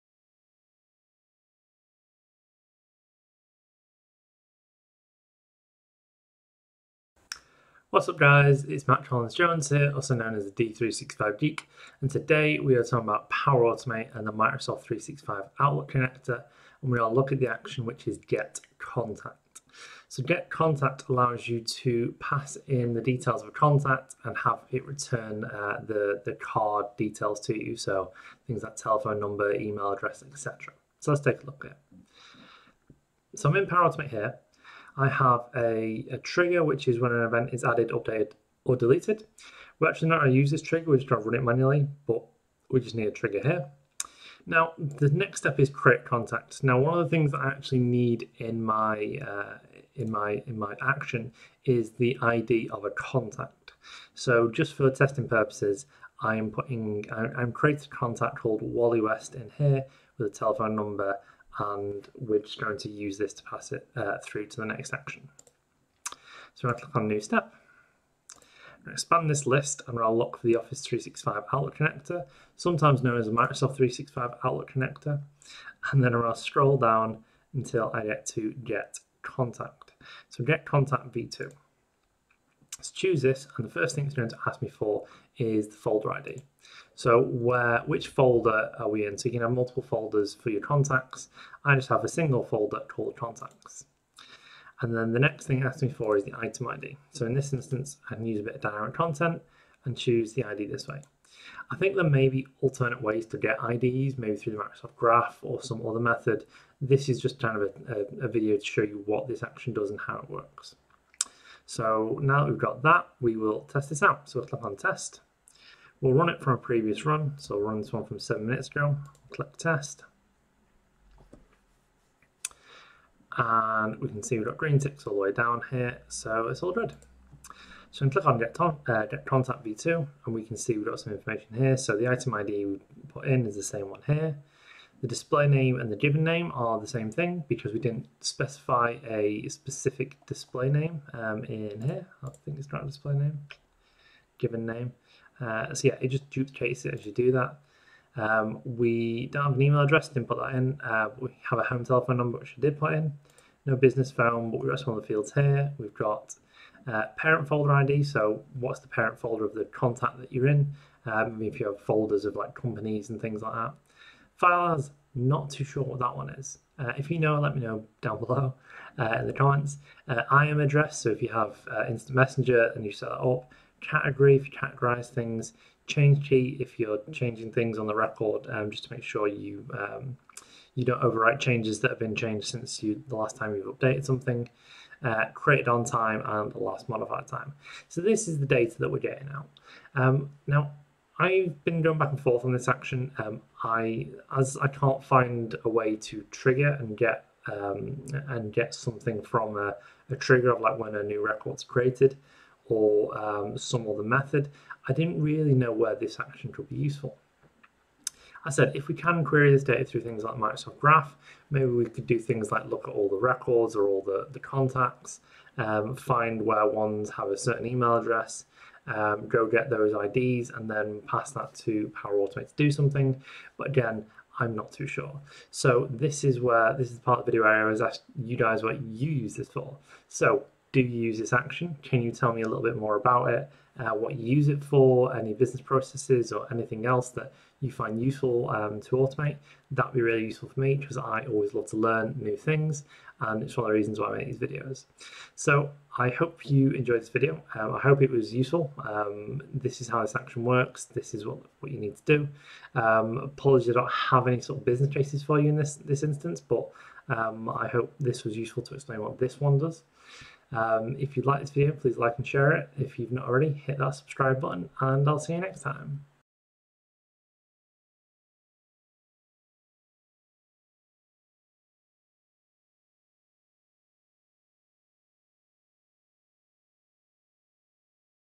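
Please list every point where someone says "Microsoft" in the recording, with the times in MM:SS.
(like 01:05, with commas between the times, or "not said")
00:14, 01:13, 01:44, 03:30.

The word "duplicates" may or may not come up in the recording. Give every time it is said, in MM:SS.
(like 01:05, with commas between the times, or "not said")
02:26.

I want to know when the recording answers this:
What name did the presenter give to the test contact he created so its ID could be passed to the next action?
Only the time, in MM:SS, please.
00:58.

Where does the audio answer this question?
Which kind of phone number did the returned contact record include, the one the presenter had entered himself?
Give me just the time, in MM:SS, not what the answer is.
02:31.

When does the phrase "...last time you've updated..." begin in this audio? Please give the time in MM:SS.
03:03.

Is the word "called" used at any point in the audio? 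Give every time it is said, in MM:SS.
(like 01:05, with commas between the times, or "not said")
00:58, 01:32.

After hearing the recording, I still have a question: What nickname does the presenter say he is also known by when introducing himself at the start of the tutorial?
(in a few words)
The D365 Geek.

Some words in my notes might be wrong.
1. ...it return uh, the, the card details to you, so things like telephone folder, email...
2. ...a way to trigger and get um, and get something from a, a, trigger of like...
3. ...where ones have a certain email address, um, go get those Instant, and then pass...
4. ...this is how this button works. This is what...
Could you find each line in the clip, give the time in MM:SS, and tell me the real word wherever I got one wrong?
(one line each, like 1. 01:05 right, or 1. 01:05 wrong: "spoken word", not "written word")
1. 00:24 wrong: "number", not "folder"
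2. 03:15 right
3. 03:36 wrong: "IDs", not "Instant"
4. 04:09 wrong: "action", not "button".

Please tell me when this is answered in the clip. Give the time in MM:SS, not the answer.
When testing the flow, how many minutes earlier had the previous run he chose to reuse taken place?
01:58.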